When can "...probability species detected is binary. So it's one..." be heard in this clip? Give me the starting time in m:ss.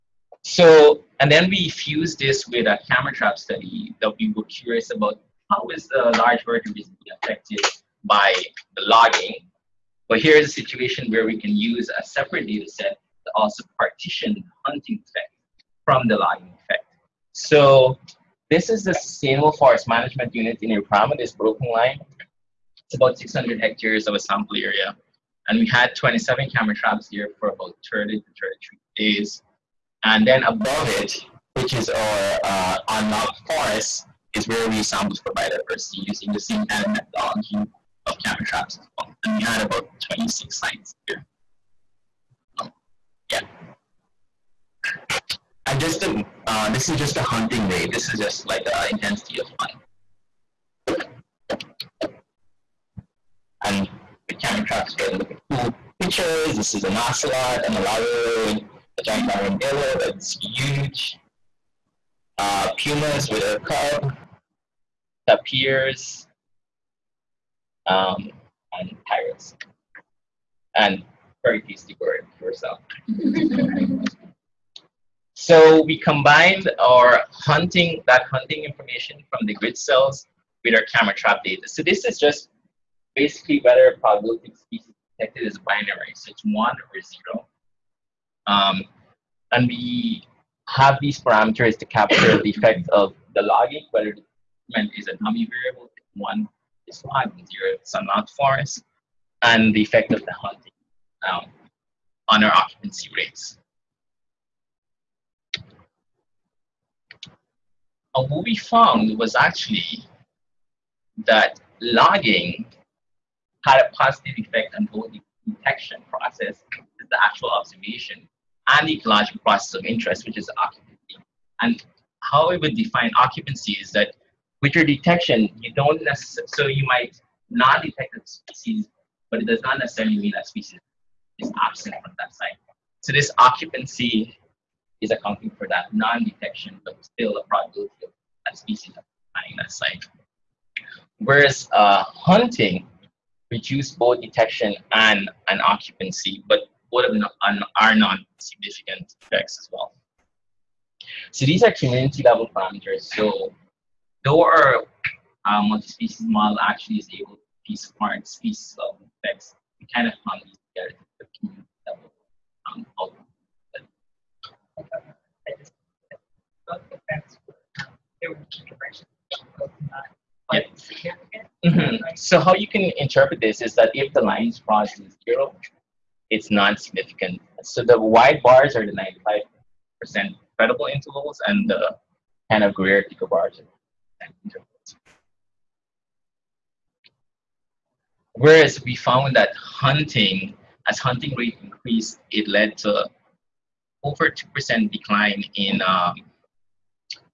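1:23.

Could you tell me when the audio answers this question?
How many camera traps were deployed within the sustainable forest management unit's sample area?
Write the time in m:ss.
0:25.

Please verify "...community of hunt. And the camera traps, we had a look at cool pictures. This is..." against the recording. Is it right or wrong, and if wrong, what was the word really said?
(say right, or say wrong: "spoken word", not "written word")
wrong: "intensity", not "community".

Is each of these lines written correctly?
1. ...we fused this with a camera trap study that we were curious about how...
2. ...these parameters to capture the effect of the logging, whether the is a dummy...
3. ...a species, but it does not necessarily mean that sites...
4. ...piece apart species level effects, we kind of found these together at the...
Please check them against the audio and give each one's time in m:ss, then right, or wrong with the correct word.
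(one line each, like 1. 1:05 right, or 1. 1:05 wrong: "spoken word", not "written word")
1. 0:01 right
2. 1:31 right
3. 2:08 wrong: "species", not "sites"
4. 2:37 right.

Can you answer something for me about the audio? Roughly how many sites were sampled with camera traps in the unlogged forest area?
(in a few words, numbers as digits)
26.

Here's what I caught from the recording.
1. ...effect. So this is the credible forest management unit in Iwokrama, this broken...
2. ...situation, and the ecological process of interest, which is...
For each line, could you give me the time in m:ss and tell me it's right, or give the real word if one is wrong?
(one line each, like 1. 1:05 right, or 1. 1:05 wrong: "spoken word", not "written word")
1. 0:16 wrong: "sustainable", not "credible"
2. 1:57 wrong: "observation", not "situation".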